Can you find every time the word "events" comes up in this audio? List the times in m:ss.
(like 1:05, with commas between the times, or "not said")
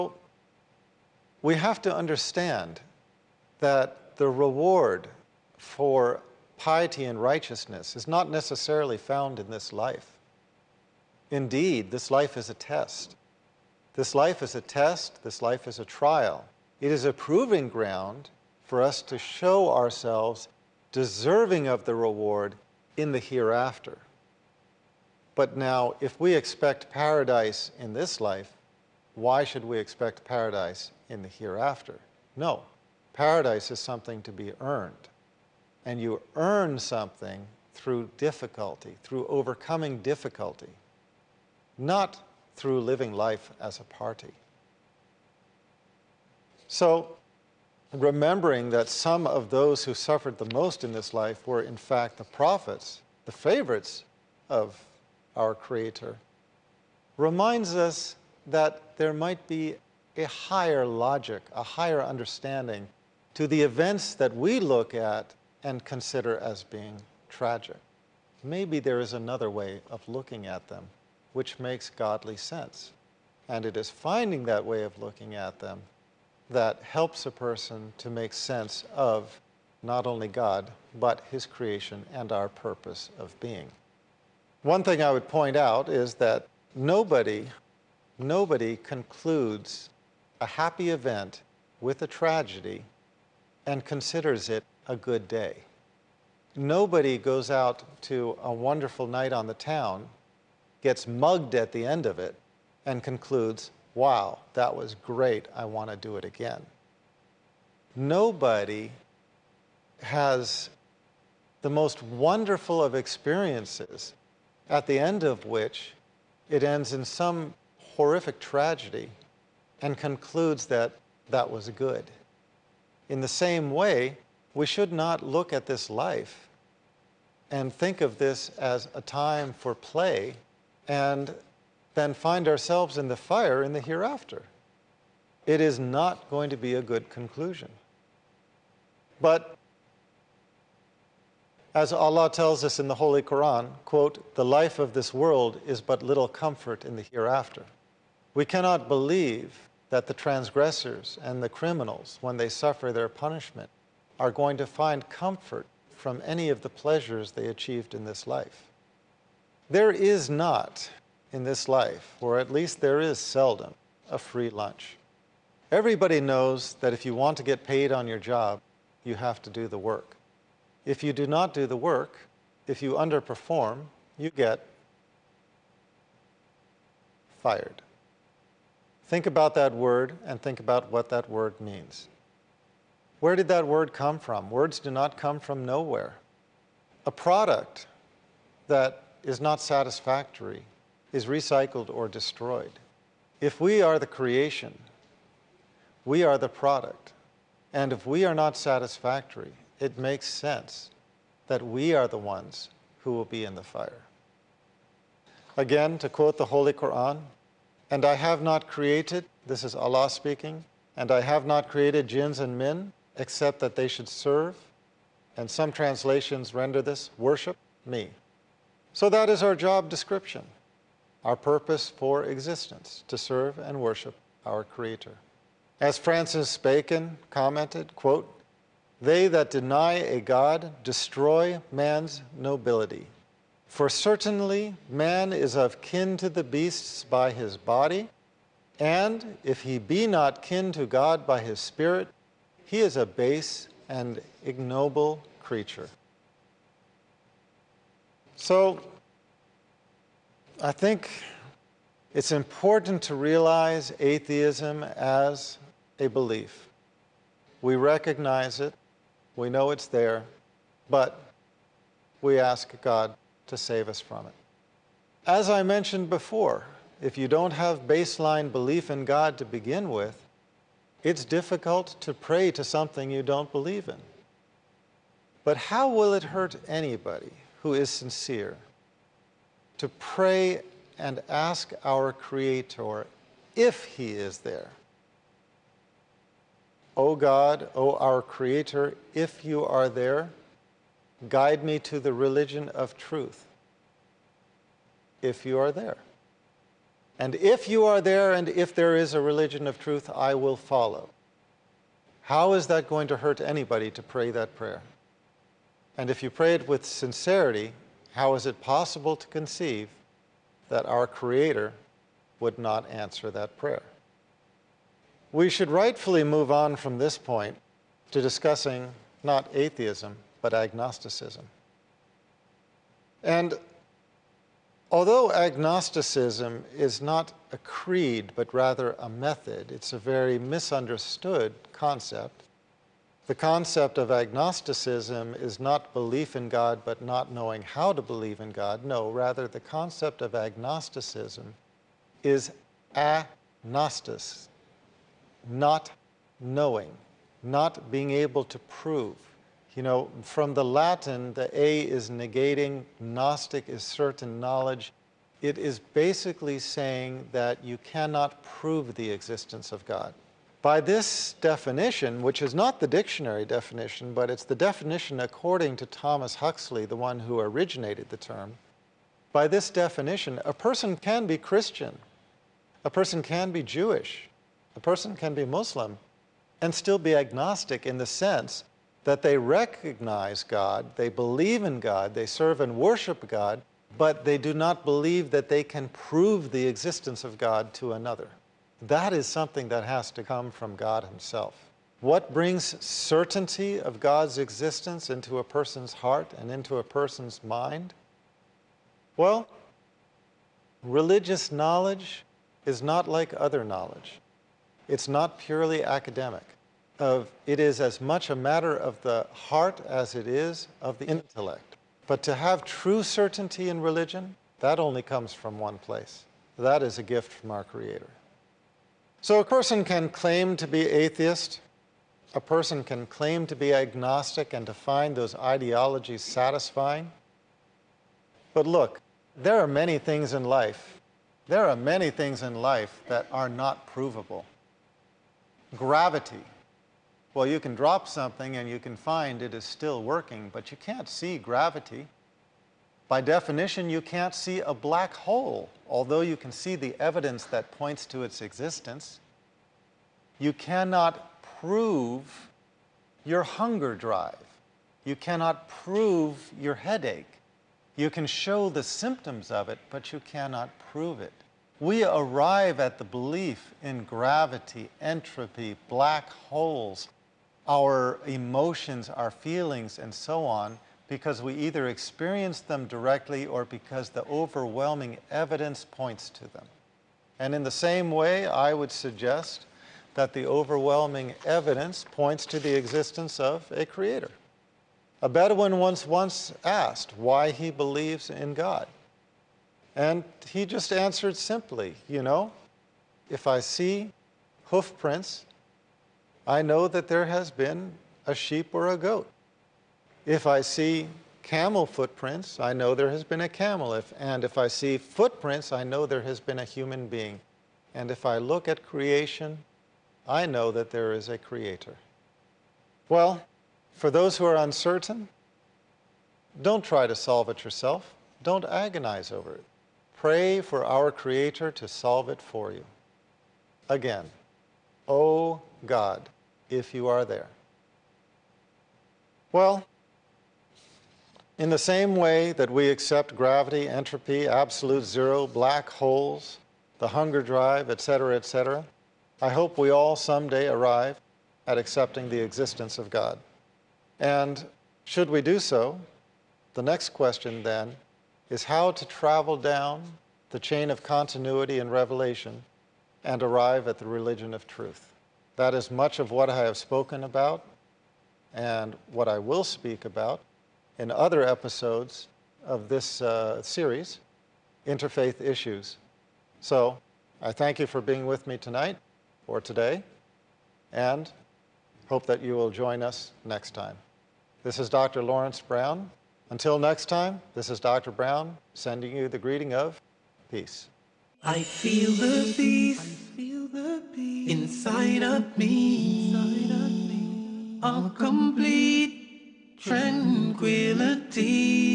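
1:03, 1:30.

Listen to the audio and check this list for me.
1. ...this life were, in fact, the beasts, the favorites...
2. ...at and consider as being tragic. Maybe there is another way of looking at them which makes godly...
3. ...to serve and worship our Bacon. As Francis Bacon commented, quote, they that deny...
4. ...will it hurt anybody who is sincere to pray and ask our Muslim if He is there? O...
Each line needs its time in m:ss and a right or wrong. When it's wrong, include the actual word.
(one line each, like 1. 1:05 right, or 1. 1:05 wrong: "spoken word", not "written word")
1. 0:50 wrong: "prophets", not "beasts"
2. 1:04 right
3. 3:43 wrong: "Creator", not "Bacon"
4. 4:35 wrong: "Creator", not "Muslim".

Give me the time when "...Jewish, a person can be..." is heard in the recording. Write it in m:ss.
6:13.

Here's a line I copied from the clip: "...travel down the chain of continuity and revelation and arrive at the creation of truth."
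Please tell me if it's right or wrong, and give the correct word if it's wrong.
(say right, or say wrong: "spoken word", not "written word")
wrong: "religion", not "creation".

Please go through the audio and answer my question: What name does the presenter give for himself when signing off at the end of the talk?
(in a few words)
Dr. Lawrence Brown.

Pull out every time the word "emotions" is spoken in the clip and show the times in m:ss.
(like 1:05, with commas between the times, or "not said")
7:48.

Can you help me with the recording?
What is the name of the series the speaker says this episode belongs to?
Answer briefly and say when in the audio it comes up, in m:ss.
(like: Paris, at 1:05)
Interfaith Issues, at 9:24.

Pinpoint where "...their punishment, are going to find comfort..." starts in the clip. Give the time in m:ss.
2:32.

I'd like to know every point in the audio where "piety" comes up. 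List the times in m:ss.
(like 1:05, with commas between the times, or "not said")
0:06.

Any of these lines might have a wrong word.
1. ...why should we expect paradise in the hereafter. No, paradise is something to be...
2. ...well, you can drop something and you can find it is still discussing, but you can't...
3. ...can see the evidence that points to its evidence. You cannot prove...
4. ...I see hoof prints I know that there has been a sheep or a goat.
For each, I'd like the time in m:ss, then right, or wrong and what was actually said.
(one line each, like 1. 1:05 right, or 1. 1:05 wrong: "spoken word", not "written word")
1. 0:29 right
2. 7:17 wrong: "working", not "discussing"
3. 7:26 wrong: "existence", not "evidence"
4. 8:13 right.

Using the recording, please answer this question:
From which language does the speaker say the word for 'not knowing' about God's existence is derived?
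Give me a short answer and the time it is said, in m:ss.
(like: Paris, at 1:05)
Latin, at 5:50.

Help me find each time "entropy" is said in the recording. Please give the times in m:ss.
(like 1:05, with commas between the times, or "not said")
7:45, 8:53.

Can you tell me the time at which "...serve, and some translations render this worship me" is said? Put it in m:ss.
3:34.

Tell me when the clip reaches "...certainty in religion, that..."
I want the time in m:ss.
6:53.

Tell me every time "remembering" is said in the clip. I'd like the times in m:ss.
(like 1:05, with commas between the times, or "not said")
0:47.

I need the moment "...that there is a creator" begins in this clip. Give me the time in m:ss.
8:30.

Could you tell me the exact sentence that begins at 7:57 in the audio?
And in the same way, I would suggest that the overwhelming evidence points to the existence of a creator.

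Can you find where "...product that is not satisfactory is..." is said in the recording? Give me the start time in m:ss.
3:07.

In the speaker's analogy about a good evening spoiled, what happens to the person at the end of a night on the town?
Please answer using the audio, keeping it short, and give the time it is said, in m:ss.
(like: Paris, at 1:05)
gets mugged, at 1:40.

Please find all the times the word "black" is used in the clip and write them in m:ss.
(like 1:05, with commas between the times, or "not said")
7:24, 7:45, 8:55.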